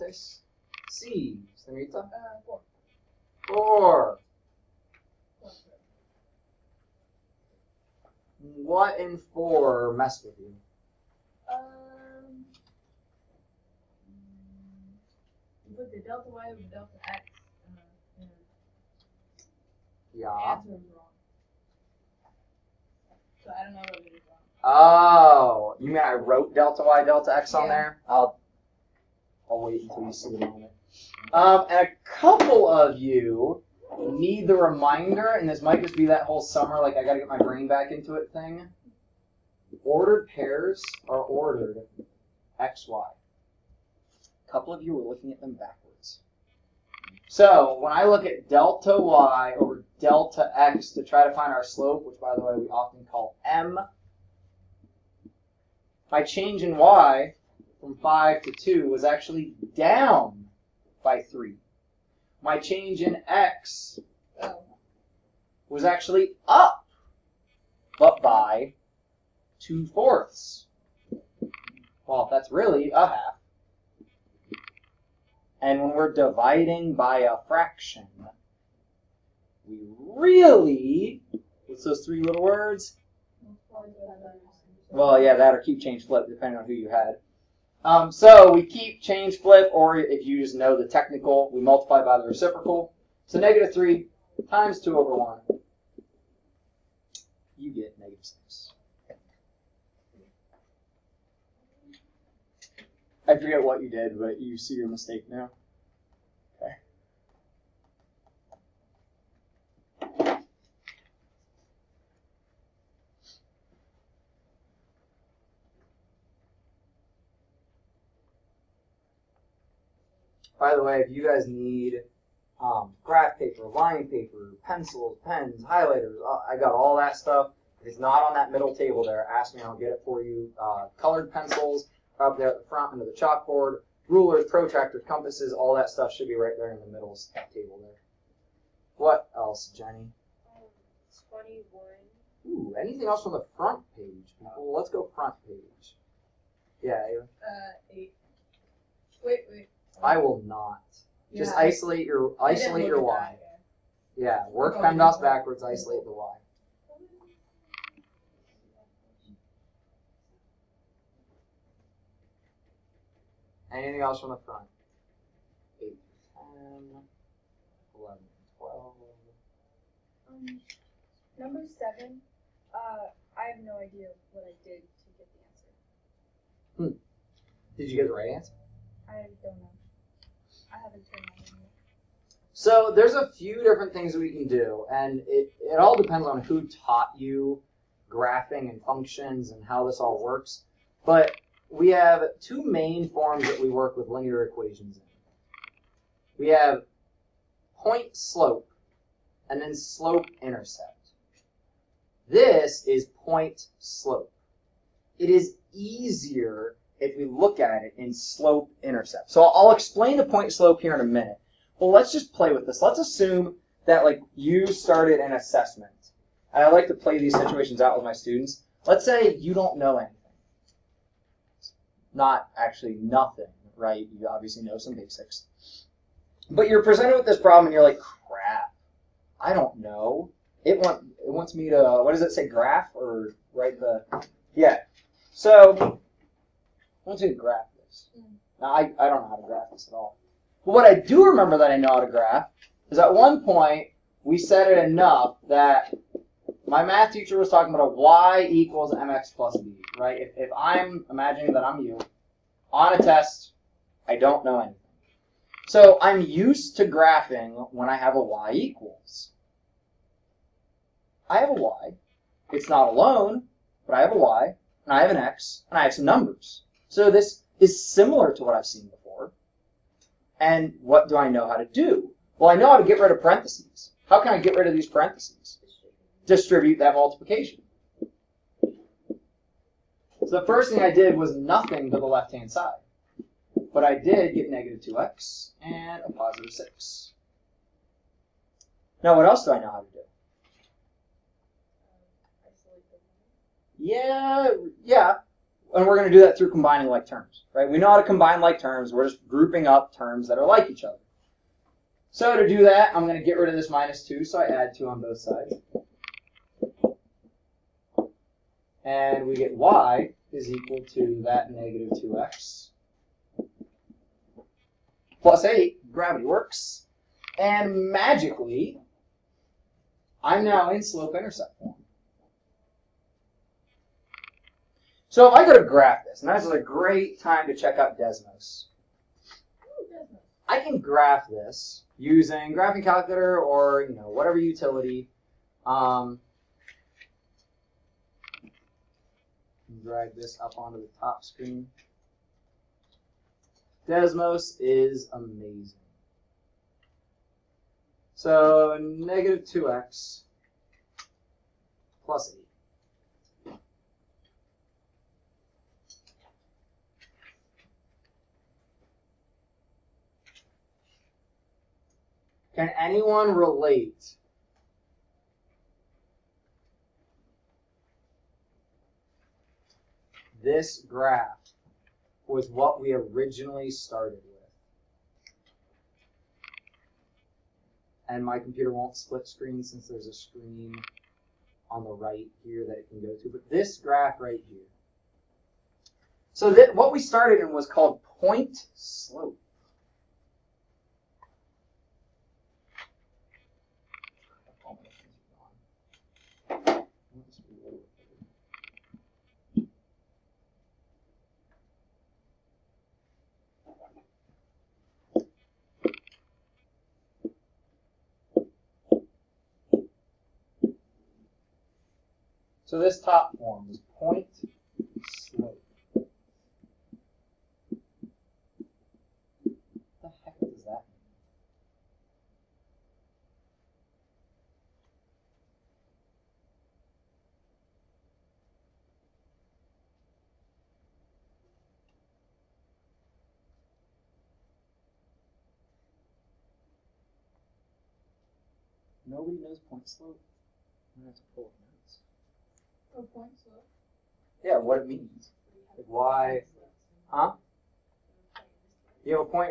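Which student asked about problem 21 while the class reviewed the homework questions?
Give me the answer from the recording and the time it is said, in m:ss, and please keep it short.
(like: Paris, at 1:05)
Jenny, at 2:19.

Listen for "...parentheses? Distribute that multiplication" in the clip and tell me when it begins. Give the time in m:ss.
4:34.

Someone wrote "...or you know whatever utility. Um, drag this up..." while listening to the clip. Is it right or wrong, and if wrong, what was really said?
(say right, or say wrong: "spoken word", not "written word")
right.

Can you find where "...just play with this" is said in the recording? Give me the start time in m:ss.
3:32.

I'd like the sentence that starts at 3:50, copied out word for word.
It, want, it wants me to, what does it say, graph or write the, yeah.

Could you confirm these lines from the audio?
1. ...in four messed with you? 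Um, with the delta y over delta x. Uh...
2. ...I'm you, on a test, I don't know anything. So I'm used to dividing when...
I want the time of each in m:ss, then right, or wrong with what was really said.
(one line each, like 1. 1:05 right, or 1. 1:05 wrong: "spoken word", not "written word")
1. 0:08 right
2. 4:11 wrong: "graphing", not "dividing".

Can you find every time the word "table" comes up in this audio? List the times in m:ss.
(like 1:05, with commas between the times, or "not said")
2:08, 2:17.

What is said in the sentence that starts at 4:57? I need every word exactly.
We know how to combine like terms.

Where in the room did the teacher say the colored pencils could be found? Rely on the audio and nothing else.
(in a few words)
under the chalkboard.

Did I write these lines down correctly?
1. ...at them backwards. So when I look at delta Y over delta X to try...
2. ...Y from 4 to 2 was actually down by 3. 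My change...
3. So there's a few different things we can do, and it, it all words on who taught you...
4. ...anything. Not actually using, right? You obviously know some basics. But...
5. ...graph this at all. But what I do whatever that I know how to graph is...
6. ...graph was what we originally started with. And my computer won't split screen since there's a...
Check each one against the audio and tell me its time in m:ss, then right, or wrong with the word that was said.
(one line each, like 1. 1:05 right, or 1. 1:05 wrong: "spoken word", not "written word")
1. 0:45 right
2. 0:56 wrong: "5", not "4"
3. 3:02 wrong: "depends", not "words"
4. 3:39 wrong: "nothing", not "using"
5. 3:59 wrong: "remember", not "whatever"
6. 6:10 right.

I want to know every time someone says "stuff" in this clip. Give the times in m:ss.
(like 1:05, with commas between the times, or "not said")
2:07, 2:15.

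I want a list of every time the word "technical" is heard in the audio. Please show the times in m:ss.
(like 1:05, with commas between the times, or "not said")
1:30.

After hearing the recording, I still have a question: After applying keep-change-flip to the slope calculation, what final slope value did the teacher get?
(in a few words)
-6.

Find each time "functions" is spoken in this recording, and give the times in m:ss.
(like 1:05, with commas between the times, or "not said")
3:08.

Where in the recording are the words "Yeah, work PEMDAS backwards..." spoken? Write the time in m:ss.
2:34.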